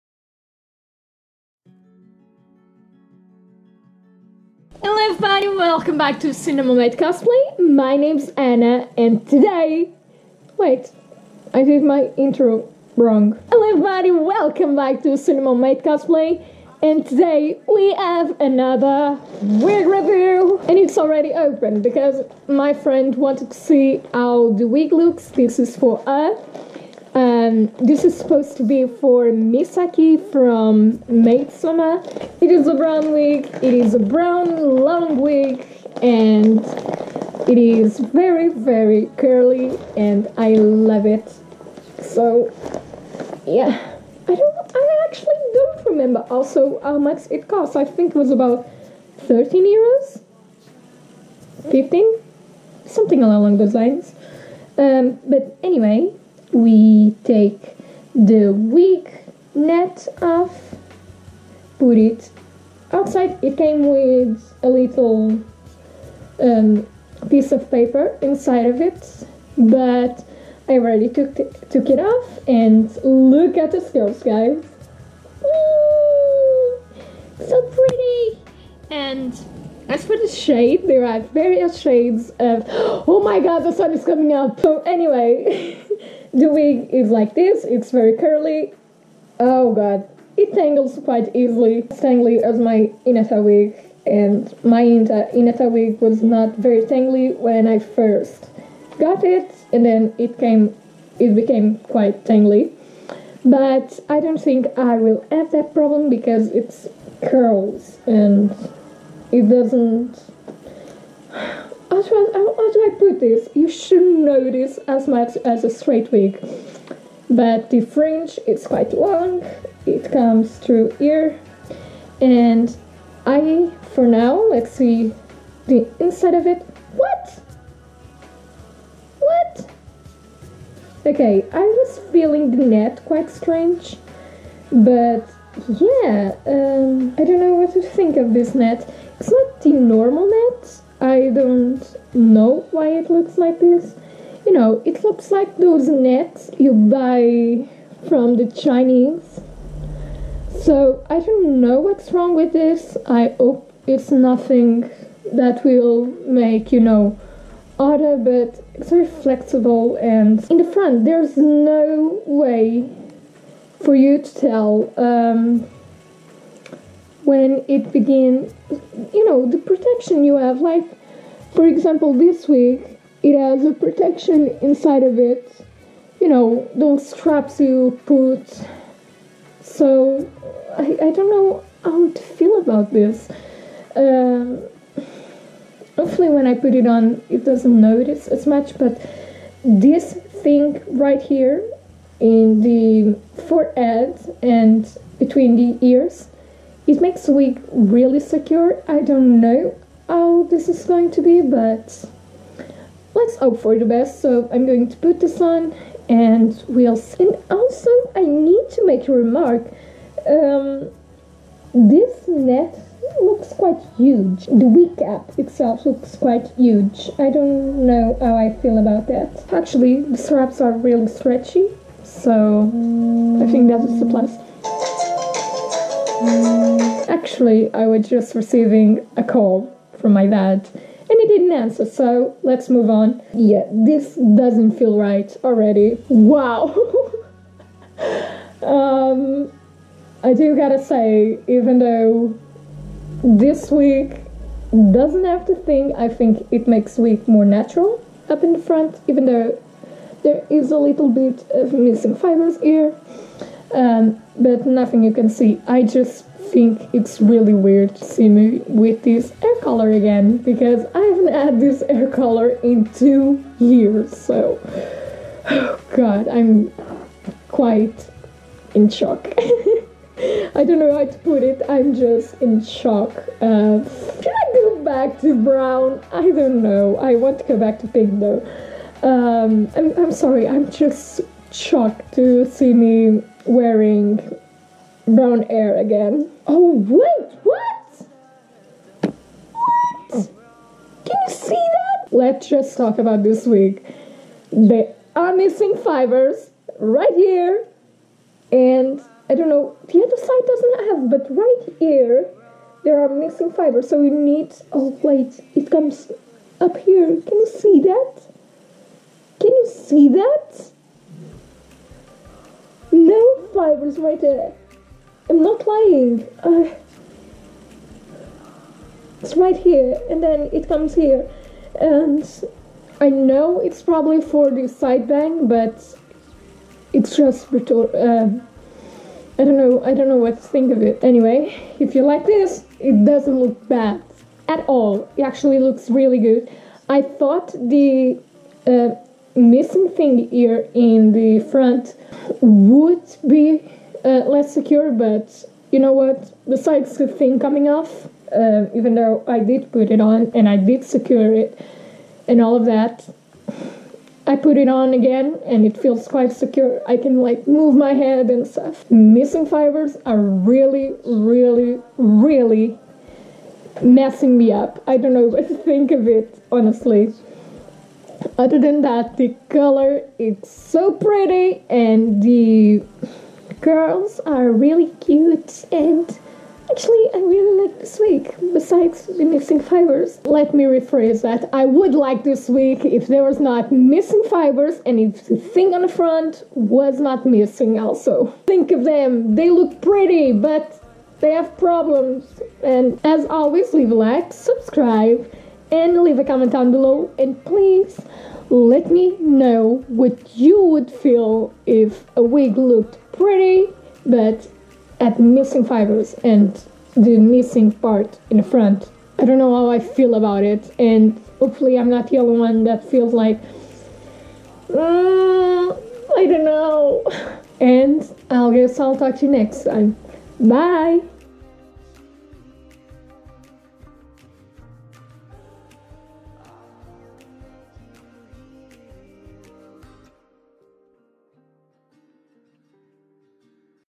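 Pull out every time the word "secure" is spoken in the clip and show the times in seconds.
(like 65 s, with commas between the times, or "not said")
198 s, 344 s, 350 s, 356 s.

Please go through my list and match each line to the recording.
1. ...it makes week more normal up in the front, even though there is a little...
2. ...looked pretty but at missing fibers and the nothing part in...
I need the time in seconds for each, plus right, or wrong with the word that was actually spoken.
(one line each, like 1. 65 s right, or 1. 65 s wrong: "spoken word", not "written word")
1. 246 s wrong: "natural", not "normal"
2. 402 s wrong: "missing", not "nothing".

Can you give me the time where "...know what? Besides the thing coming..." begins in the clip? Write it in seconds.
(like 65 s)
345 s.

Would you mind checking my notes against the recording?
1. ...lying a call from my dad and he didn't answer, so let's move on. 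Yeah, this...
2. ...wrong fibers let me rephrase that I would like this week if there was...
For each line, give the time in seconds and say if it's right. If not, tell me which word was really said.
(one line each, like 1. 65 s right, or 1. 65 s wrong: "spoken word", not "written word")
1. 228 s wrong: "receiving", not "lying"
2. 379 s wrong: "missing", not "wrong".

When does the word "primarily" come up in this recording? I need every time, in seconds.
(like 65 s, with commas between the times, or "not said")
not said.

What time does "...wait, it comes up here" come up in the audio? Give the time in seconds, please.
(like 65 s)
305 s.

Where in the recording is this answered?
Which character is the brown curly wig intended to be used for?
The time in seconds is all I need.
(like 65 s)
29 s.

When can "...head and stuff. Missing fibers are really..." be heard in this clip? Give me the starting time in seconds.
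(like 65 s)
357 s.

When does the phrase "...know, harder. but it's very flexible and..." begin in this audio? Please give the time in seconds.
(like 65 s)
156 s.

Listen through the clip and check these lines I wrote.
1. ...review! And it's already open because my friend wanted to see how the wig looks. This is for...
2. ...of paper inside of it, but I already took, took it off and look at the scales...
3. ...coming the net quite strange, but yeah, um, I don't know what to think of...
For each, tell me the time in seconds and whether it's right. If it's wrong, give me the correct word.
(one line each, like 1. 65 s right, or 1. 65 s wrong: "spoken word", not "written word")
1. 19 s right
2. 67 s right
3. 132 s wrong: "feeling", not "coming".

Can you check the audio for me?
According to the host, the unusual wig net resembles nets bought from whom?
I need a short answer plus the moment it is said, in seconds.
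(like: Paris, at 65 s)
the Chinese, at 148 s.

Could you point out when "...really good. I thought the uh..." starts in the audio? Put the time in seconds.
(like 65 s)
335 s.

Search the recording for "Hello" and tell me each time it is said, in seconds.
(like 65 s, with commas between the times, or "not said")
4 s, 13 s.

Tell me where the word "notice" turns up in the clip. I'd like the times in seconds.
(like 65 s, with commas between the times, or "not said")
187 s.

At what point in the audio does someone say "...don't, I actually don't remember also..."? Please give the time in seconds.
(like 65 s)
44 s.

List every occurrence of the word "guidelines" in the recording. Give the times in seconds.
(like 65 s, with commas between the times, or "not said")
not said.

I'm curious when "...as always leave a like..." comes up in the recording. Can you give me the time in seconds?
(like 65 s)
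393 s.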